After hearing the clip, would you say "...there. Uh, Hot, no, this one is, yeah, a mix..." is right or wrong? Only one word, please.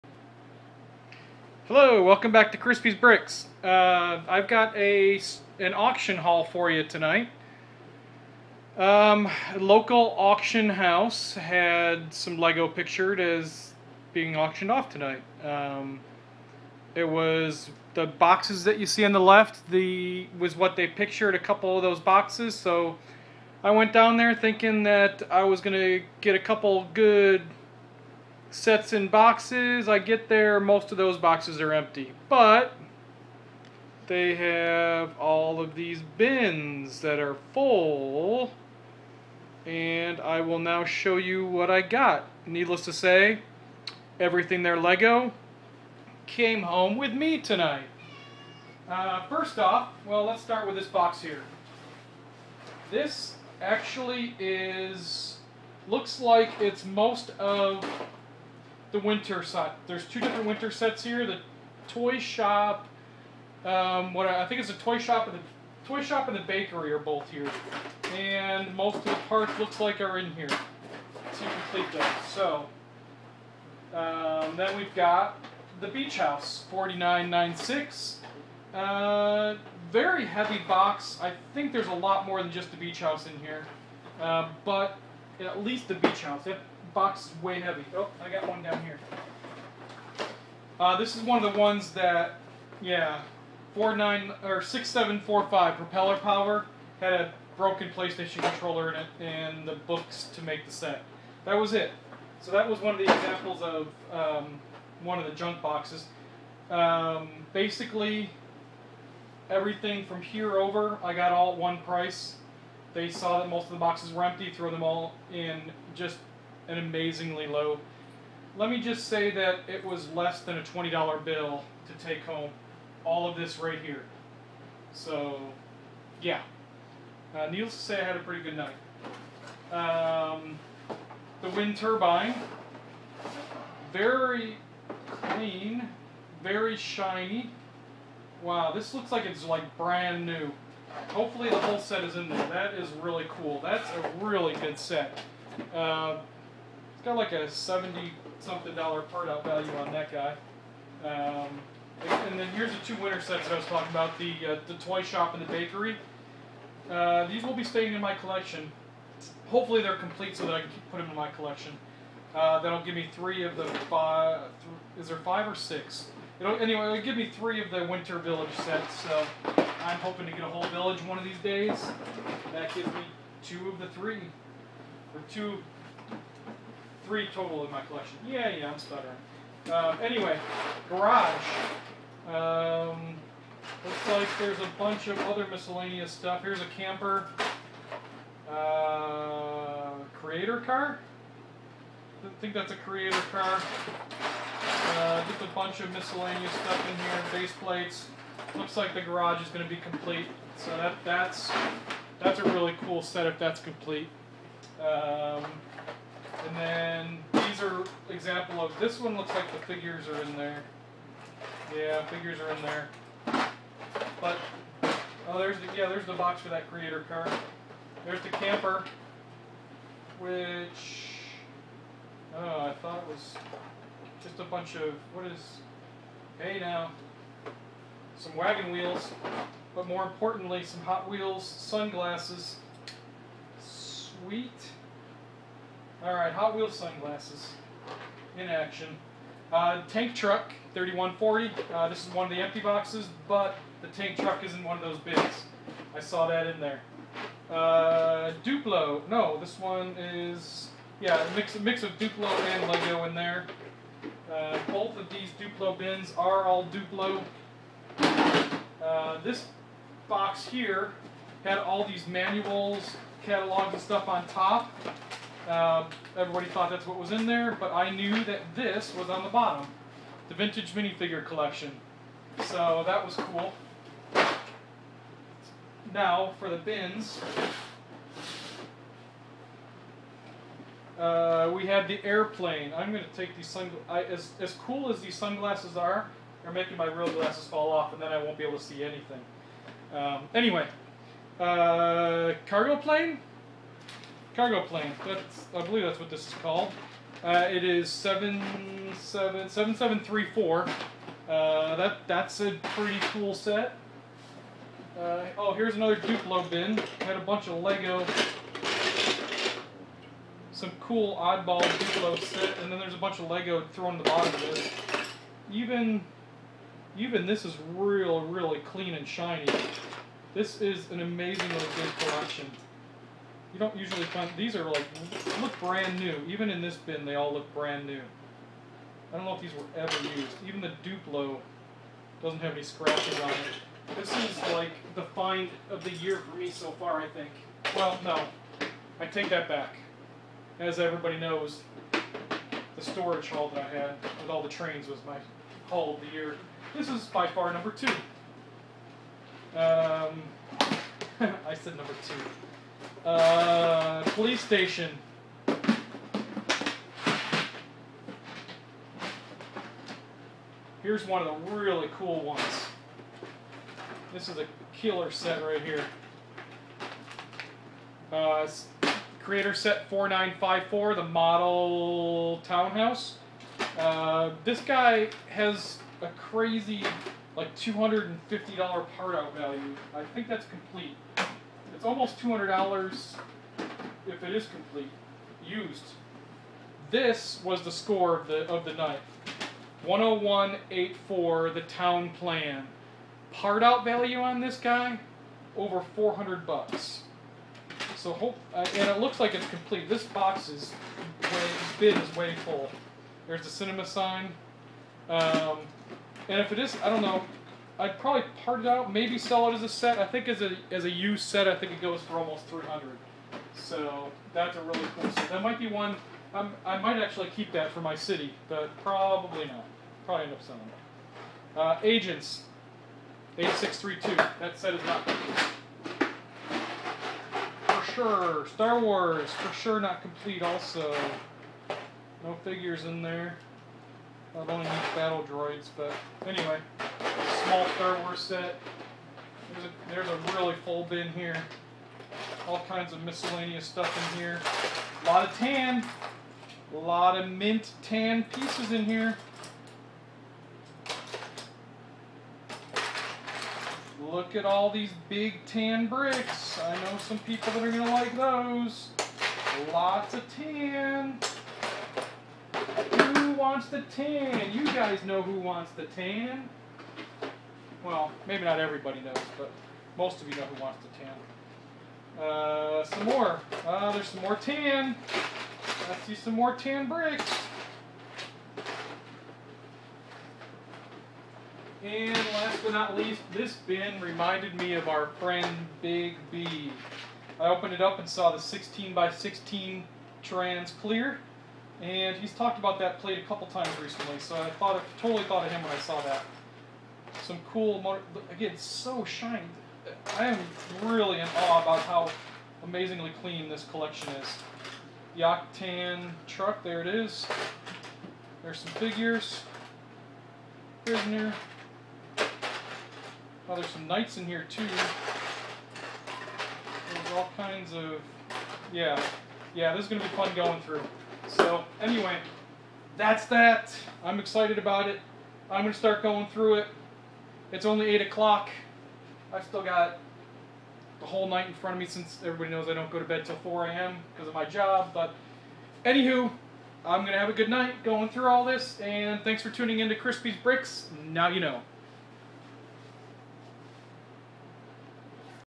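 wrong.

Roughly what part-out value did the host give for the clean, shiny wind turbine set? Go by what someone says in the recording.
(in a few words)
70 something dollars.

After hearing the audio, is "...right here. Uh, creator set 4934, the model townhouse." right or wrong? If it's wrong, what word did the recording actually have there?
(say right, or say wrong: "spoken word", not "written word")
wrong: "4954", not "4934".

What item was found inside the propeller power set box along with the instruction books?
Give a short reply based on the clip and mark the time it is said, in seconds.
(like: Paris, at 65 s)
broken PlayStation controller, at 97 s.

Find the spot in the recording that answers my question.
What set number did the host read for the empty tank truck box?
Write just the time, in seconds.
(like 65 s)
240 s.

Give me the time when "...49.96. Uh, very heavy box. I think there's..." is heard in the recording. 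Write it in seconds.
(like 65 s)
76 s.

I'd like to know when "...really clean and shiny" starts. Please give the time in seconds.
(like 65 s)
318 s.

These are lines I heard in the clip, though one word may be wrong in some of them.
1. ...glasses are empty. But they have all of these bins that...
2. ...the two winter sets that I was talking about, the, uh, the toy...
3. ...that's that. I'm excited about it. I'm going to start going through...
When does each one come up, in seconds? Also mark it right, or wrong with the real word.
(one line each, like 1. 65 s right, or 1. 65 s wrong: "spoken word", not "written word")
1. 31 s wrong: "boxes", not "glasses"
2. 152 s right
3. 522 s right.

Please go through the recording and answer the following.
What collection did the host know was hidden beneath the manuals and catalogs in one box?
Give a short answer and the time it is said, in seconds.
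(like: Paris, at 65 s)
vintage minifigure collection, at 270 s.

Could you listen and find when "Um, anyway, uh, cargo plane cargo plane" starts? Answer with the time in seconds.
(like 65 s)
289 s.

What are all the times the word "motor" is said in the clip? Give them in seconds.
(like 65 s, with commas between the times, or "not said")
497 s.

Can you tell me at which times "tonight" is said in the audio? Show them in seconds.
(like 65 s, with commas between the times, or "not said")
6 s, 14 s, 47 s.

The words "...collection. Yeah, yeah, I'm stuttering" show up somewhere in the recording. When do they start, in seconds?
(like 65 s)
177 s.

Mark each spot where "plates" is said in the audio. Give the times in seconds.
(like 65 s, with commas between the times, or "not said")
197 s, 492 s.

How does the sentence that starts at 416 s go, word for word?
I'm, i might actually keep that for my city, but probably not.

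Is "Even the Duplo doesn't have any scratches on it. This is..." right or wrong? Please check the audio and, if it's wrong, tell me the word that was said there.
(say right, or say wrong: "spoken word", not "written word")
right.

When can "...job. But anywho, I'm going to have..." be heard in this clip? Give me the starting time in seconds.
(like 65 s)
534 s.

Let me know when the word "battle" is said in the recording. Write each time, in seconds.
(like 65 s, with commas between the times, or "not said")
434 s.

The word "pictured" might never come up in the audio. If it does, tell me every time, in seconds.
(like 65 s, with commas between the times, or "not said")
12 s, 20 s.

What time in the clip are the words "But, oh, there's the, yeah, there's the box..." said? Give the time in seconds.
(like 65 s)
214 s.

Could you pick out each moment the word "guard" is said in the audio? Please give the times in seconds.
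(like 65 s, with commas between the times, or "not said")
not said.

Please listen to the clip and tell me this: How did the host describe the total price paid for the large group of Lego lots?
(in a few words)
less than a $20 bill.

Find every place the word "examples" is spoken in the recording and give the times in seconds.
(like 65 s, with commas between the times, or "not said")
103 s, 208 s.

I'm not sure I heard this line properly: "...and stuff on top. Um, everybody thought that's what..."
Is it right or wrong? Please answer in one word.
right.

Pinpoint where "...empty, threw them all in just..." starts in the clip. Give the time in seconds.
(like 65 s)
114 s.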